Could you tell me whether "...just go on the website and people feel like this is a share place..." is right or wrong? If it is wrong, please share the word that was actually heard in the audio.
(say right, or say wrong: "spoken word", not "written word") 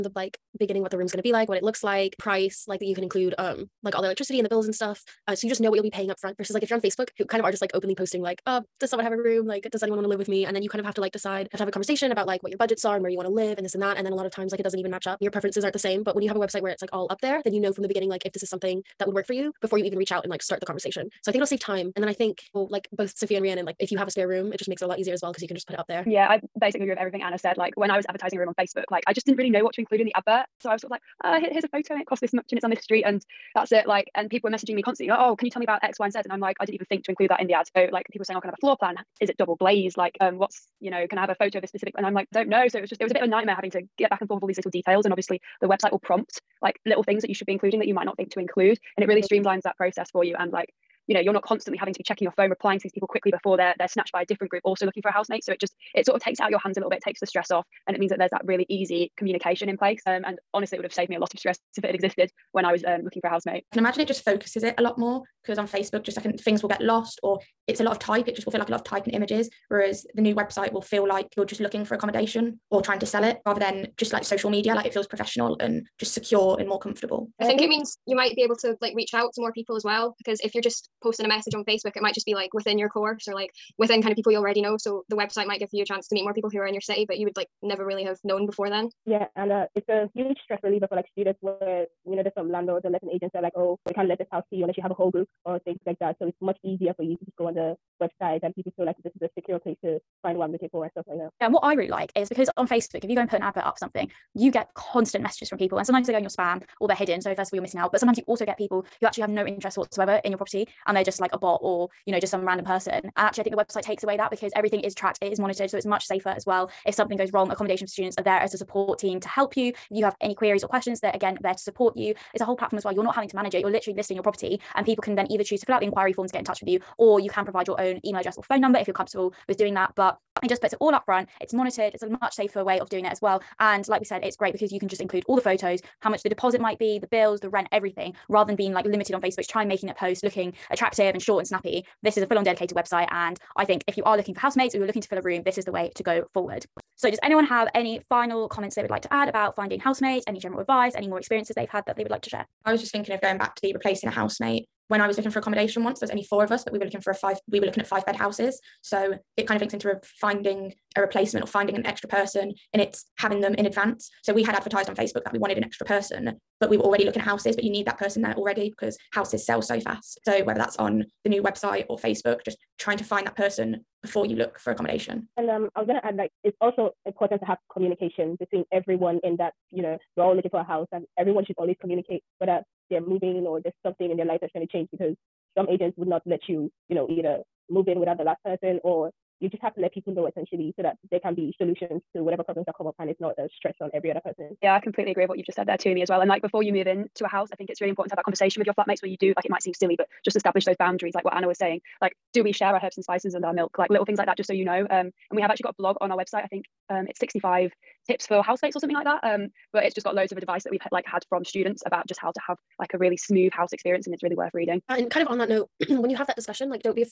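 wrong: "secure", not "share".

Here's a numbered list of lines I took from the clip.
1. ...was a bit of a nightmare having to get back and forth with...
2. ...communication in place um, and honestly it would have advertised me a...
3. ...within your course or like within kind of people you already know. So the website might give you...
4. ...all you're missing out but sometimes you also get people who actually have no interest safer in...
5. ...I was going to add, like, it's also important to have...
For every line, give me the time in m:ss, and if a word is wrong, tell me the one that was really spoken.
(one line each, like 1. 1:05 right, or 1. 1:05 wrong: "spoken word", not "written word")
1. 0:43 right
2. 0:59 wrong: "saved", not "advertised"
3. 1:22 right
4. 1:47 wrong: "whatsoever", not "safer"
5. 2:55 right.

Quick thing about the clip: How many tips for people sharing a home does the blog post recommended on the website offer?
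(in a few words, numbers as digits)
65.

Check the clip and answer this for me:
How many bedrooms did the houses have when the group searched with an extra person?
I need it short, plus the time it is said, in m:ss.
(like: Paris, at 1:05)
5, at 2:37.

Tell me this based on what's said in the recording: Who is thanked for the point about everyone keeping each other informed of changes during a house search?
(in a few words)
Tumi.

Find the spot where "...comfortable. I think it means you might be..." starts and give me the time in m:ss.
1:16.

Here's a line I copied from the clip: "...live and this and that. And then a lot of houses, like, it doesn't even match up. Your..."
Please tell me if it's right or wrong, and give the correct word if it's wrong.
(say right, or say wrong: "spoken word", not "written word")
wrong: "times", not "houses".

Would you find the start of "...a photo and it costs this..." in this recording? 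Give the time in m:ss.
0:31.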